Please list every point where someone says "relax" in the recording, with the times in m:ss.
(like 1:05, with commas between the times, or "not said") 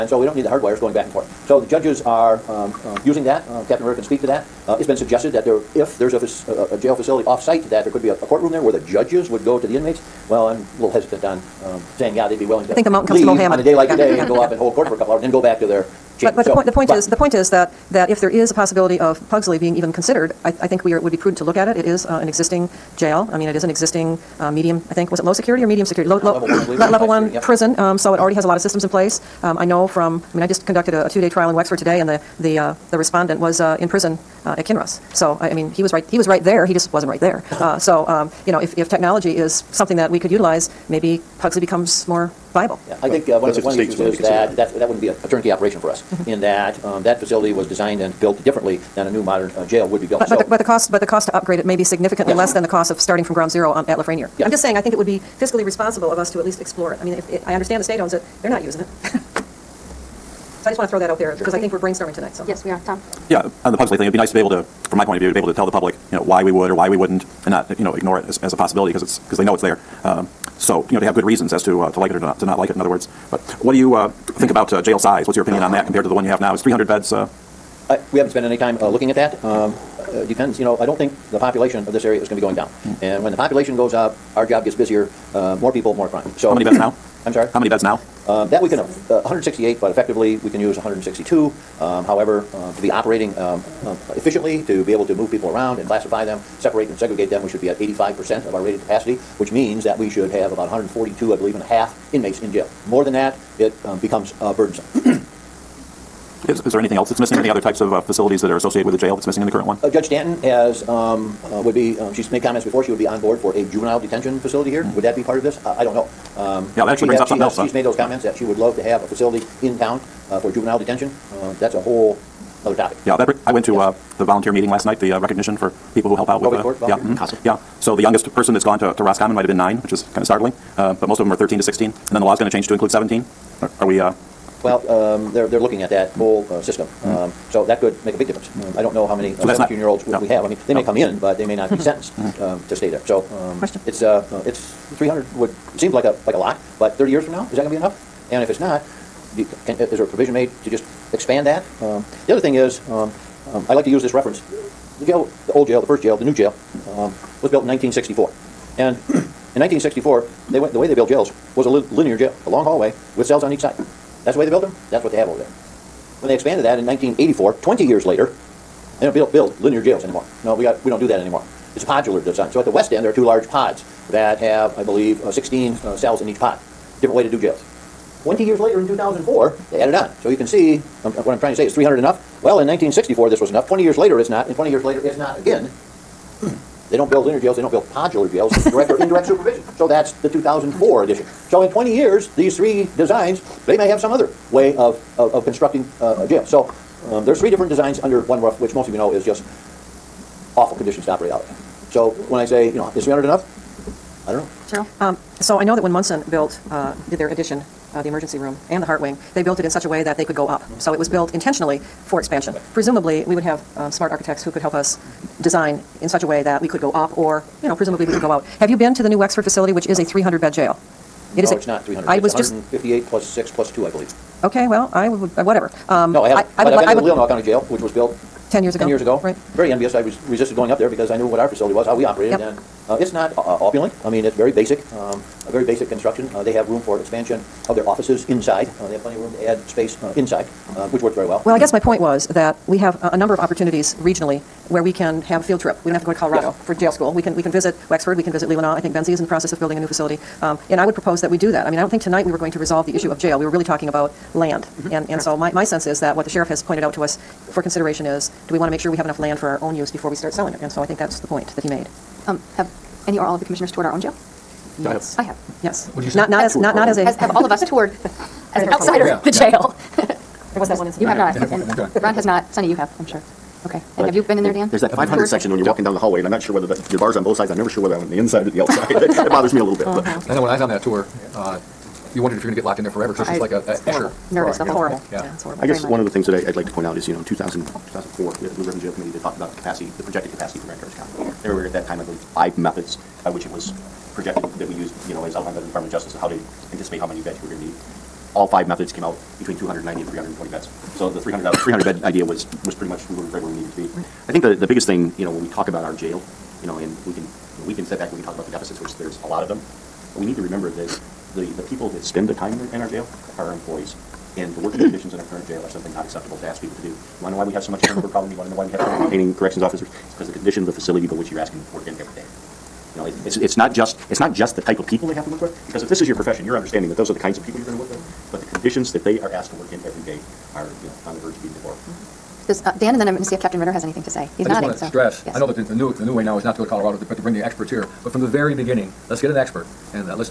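not said.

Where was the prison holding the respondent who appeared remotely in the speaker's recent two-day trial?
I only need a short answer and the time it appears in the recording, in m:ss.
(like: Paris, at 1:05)
Kinross, at 0:34.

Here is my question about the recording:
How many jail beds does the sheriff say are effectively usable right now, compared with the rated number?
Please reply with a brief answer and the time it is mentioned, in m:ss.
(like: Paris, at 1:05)
162, at 1:30.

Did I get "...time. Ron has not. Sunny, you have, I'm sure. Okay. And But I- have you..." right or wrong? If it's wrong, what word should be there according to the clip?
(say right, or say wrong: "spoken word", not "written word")
right.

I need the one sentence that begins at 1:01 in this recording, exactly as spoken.
because I think we're brainstorming tonight, so.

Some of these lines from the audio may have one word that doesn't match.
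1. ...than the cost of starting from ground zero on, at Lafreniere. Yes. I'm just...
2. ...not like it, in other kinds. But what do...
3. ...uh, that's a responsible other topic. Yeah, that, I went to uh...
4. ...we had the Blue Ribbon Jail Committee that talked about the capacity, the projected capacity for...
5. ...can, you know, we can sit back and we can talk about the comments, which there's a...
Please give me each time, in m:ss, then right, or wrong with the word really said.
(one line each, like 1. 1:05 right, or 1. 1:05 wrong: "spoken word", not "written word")
1. 0:52 right
2. 1:12 wrong: "words", not "kinds"
3. 2:01 wrong: "whole", not "responsible"
4. 4:48 right
5. 5:07 wrong: "deficits", not "comments".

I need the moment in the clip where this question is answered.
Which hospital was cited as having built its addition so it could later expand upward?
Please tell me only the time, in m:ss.
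3:25.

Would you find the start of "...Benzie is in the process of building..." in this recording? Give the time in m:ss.
4:08.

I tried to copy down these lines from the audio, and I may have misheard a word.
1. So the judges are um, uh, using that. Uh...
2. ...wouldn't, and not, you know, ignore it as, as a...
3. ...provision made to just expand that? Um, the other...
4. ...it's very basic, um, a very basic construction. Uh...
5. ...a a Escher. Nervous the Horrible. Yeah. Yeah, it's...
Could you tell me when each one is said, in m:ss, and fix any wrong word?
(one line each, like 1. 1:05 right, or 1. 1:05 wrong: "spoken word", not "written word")
1. 0:01 right
2. 1:06 right
3. 2:30 right
4. 3:54 right
5. 4:43 right.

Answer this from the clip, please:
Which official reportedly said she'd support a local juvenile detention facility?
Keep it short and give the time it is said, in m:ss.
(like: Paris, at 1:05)
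Judge Stanton, at 1:49.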